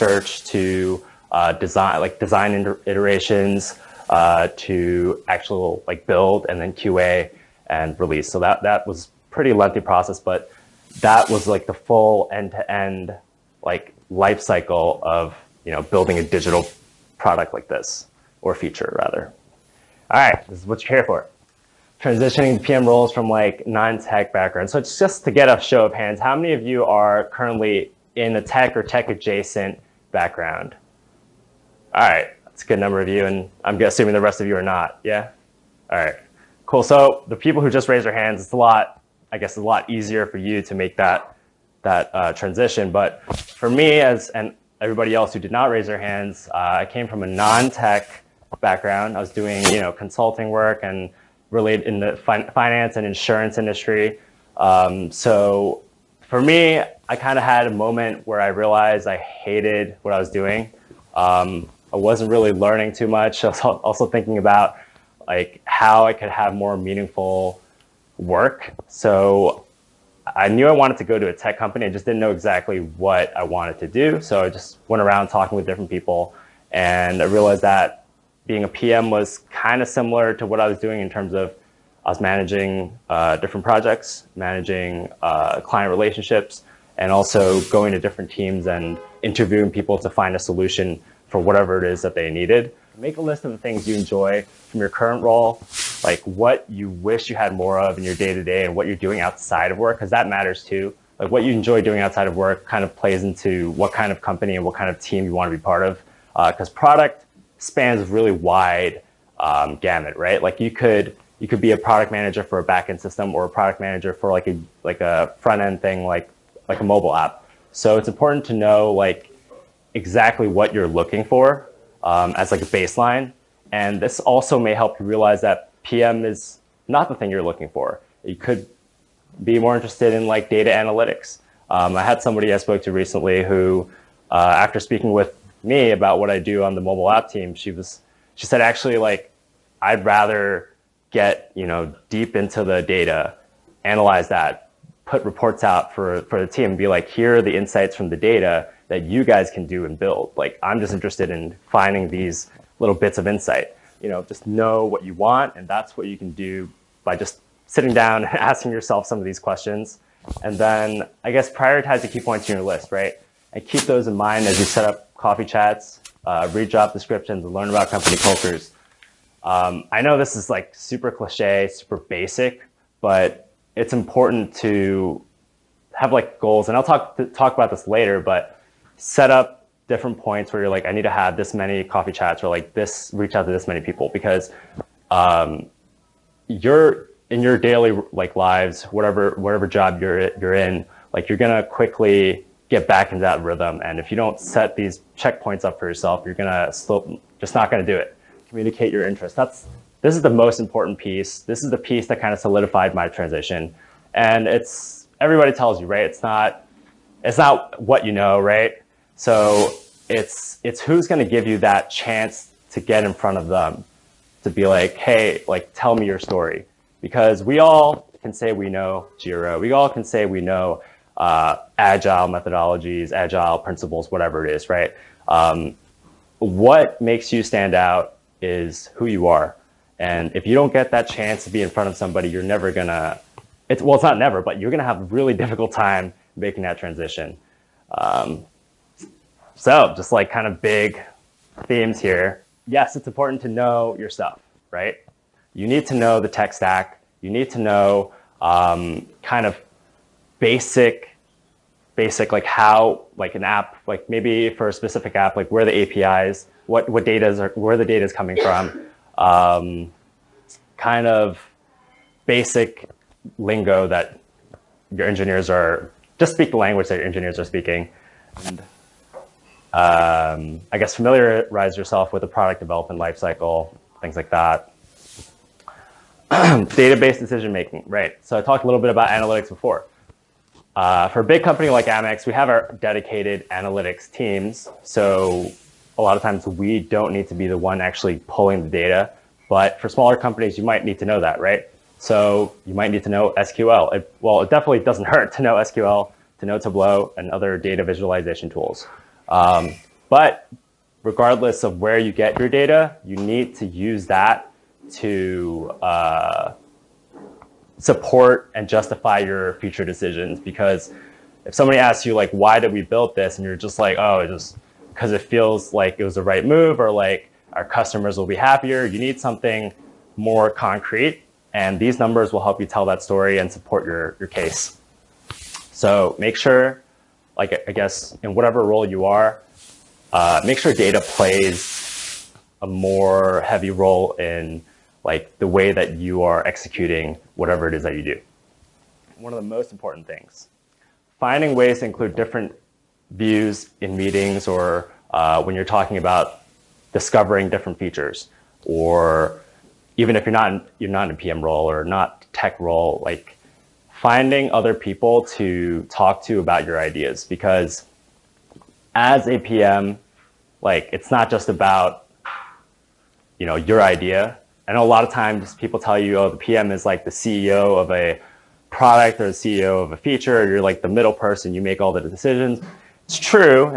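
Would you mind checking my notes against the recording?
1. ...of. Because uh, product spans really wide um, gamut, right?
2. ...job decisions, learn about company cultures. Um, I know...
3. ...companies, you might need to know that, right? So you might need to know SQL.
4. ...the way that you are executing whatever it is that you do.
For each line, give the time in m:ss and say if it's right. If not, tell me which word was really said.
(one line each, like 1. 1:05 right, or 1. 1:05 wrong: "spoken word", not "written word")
1. 1:45 right
2. 2:46 wrong: "descriptions", not "decisions"
3. 4:50 right
4. 5:35 right.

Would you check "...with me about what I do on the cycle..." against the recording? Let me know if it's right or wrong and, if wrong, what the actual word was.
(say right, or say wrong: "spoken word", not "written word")
wrong: "mobile", not "cycle".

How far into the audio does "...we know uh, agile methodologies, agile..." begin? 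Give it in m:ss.
3:40.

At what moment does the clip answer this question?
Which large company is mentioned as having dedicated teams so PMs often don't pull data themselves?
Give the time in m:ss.
4:41.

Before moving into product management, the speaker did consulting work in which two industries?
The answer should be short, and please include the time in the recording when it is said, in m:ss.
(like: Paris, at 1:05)
finance and insurance, at 0:52.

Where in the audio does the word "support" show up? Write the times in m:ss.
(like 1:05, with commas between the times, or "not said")
5:07, 5:23.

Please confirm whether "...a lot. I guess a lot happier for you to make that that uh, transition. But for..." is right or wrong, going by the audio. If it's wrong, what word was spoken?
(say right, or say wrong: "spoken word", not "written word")
wrong: "easier", not "happier".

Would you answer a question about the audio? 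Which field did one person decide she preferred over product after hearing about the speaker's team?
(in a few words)
data analytics.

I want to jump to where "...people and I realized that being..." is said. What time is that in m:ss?
1:15.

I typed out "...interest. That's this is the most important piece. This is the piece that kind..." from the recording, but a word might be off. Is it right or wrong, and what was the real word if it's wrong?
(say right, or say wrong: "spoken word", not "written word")
right.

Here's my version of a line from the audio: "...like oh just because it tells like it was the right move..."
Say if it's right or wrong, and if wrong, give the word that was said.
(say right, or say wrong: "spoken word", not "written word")
wrong: "feels", not "tells".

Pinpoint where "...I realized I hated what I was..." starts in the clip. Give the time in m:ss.
0:58.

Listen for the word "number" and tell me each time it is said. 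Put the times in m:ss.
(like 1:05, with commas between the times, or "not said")
0:32, 5:21.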